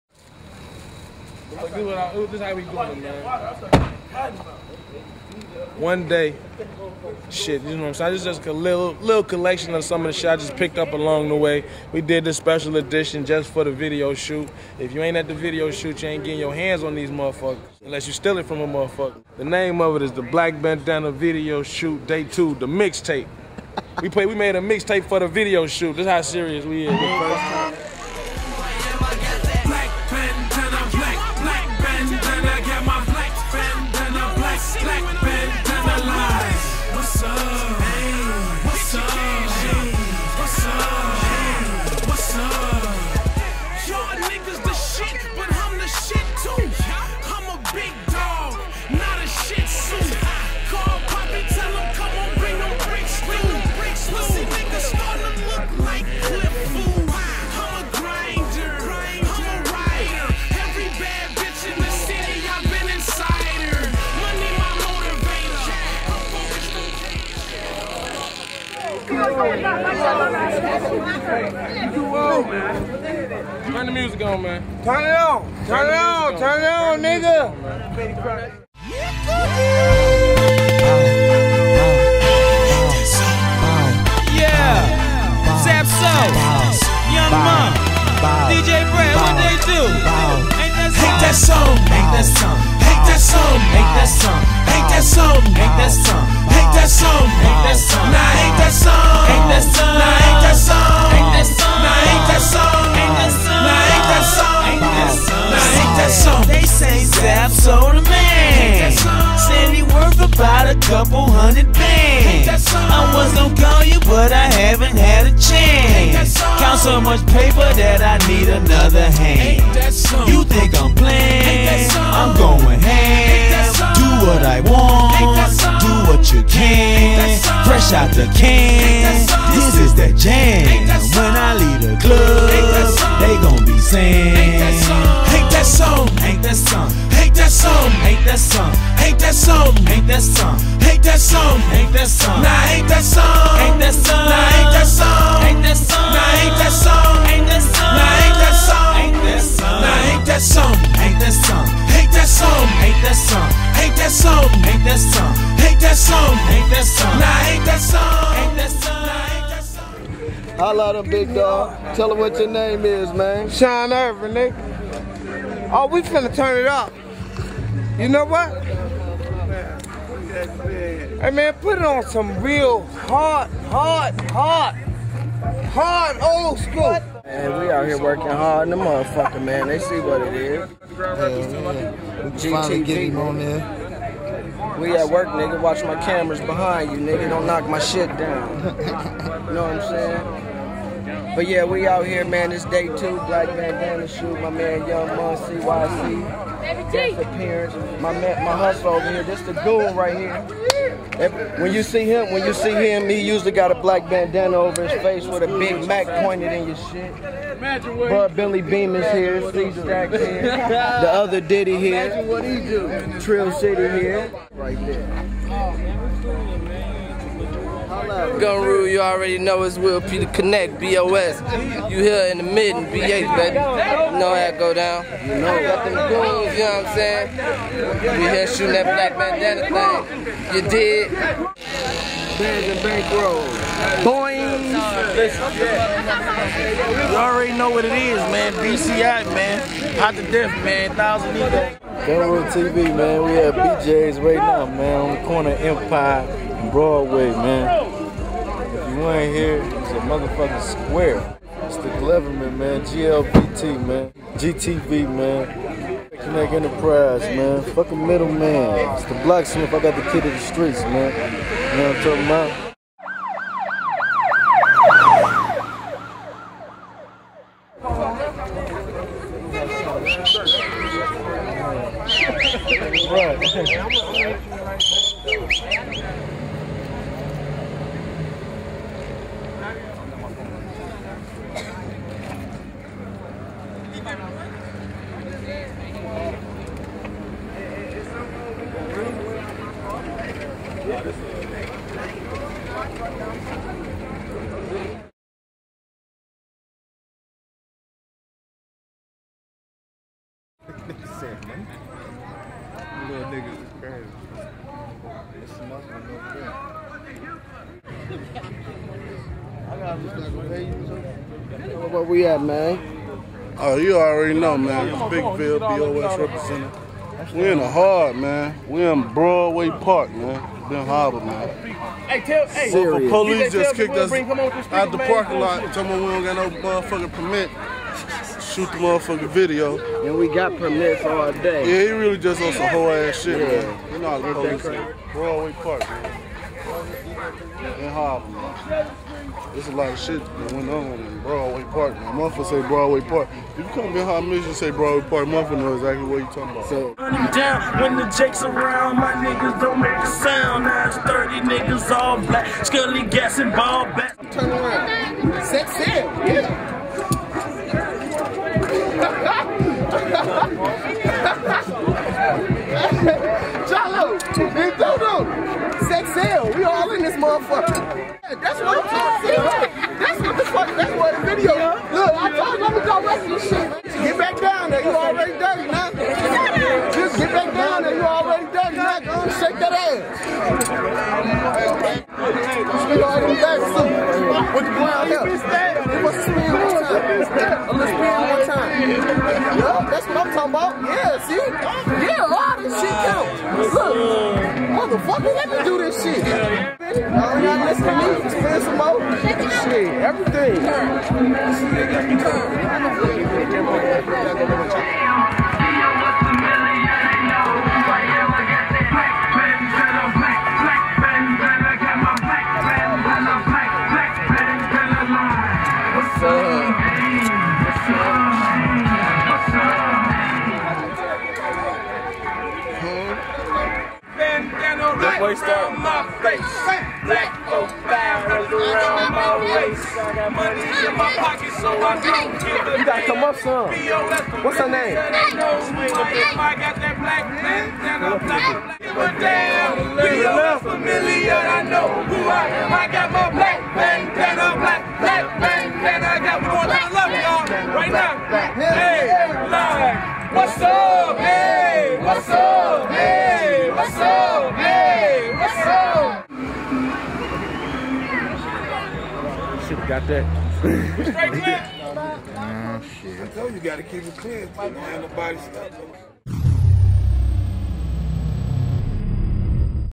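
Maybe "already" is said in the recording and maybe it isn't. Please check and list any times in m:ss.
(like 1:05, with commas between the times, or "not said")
3:38, 3:57, 5:13.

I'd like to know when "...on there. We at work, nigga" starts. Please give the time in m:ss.
3:03.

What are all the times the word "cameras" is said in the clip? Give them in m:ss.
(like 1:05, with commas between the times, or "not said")
3:06.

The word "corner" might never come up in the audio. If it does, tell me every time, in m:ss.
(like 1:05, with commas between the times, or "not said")
4:05.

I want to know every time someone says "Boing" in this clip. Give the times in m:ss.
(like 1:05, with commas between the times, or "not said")
3:54.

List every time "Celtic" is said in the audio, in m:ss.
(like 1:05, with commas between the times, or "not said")
not said.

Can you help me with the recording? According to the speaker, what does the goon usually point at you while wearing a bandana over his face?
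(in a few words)
Big Mac.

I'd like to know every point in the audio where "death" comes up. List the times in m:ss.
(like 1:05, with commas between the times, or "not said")
4:00.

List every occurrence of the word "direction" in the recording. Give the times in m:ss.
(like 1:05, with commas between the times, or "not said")
not said.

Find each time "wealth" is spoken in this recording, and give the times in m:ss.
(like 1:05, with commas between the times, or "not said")
not said.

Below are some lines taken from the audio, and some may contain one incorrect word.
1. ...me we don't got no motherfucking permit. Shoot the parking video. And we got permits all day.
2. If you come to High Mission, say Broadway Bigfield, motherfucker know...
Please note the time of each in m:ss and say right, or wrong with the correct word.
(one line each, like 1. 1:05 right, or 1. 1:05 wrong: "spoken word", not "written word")
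1. 5:25 wrong: "motherfucking", not "parking"
2. 5:43 wrong: "Park", not "Bigfield".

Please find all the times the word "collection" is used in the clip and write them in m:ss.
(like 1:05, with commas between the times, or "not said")
0:09.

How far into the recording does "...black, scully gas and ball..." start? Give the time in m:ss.
5:52.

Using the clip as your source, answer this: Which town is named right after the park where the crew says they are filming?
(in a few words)
Benton Harbor.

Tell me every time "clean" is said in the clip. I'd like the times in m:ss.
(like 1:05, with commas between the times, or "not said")
7:44.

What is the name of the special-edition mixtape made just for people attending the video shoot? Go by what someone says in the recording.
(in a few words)
Black Bandana Video Shoot Day 2.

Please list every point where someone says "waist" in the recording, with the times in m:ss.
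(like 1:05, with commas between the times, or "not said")
7:05, 7:09.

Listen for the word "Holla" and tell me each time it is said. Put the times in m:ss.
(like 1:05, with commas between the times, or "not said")
2:40.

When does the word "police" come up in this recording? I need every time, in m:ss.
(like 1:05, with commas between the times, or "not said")
5:23, 5:34.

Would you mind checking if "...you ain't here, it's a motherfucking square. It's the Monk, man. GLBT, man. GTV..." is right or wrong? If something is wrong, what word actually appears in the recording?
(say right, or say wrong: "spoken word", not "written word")
wrong: "Gloverman", not "Monk".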